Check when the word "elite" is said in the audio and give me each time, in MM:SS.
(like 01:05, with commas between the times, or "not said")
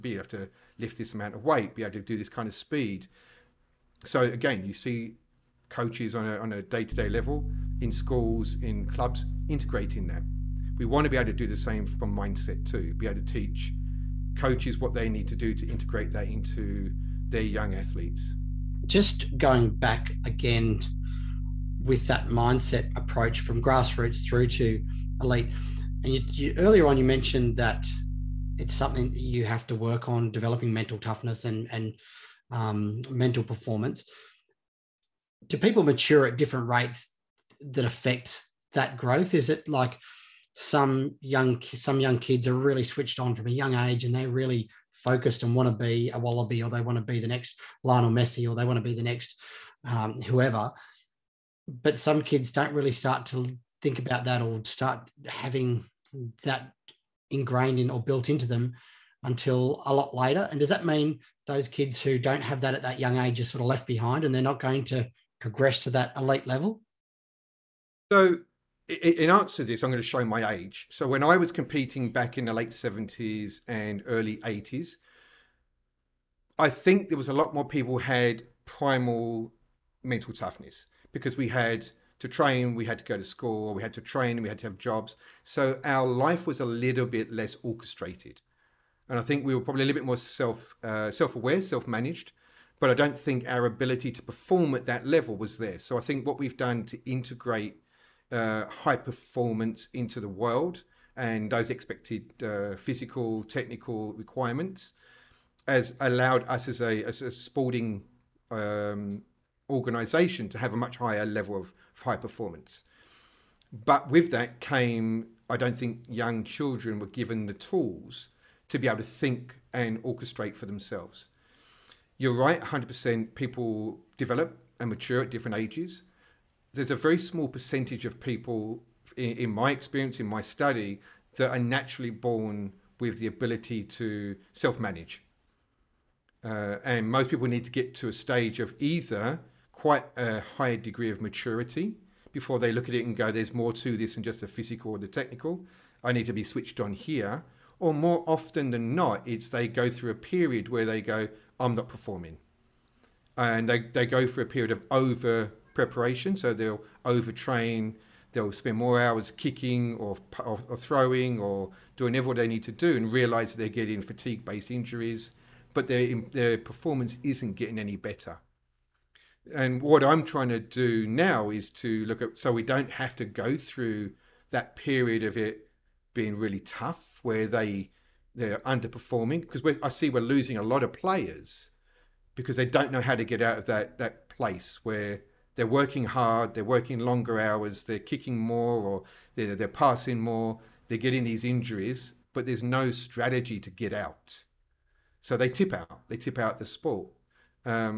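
00:25, 01:06.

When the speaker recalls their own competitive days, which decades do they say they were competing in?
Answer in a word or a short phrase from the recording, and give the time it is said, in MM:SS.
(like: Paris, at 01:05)
late 70s and early 80s, at 01:12.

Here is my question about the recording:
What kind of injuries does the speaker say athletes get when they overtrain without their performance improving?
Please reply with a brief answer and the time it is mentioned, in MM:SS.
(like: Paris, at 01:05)
fatigue based injuries, at 02:44.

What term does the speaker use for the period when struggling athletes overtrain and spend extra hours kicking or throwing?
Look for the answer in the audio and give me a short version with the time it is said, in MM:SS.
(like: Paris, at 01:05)
over preparation, at 02:34.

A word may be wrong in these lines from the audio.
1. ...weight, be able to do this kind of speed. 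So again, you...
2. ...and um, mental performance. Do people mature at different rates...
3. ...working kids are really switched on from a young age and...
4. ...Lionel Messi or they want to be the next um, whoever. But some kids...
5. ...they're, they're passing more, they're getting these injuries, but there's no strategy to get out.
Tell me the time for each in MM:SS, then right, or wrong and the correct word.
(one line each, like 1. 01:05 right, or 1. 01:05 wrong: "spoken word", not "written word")
1. 00:01 right
2. 00:31 right
3. 00:41 wrong: "young", not "working"
4. 00:47 right
5. 03:09 right.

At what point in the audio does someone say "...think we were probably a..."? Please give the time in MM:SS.
01:29.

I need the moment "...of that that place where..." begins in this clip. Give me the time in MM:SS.
03:03.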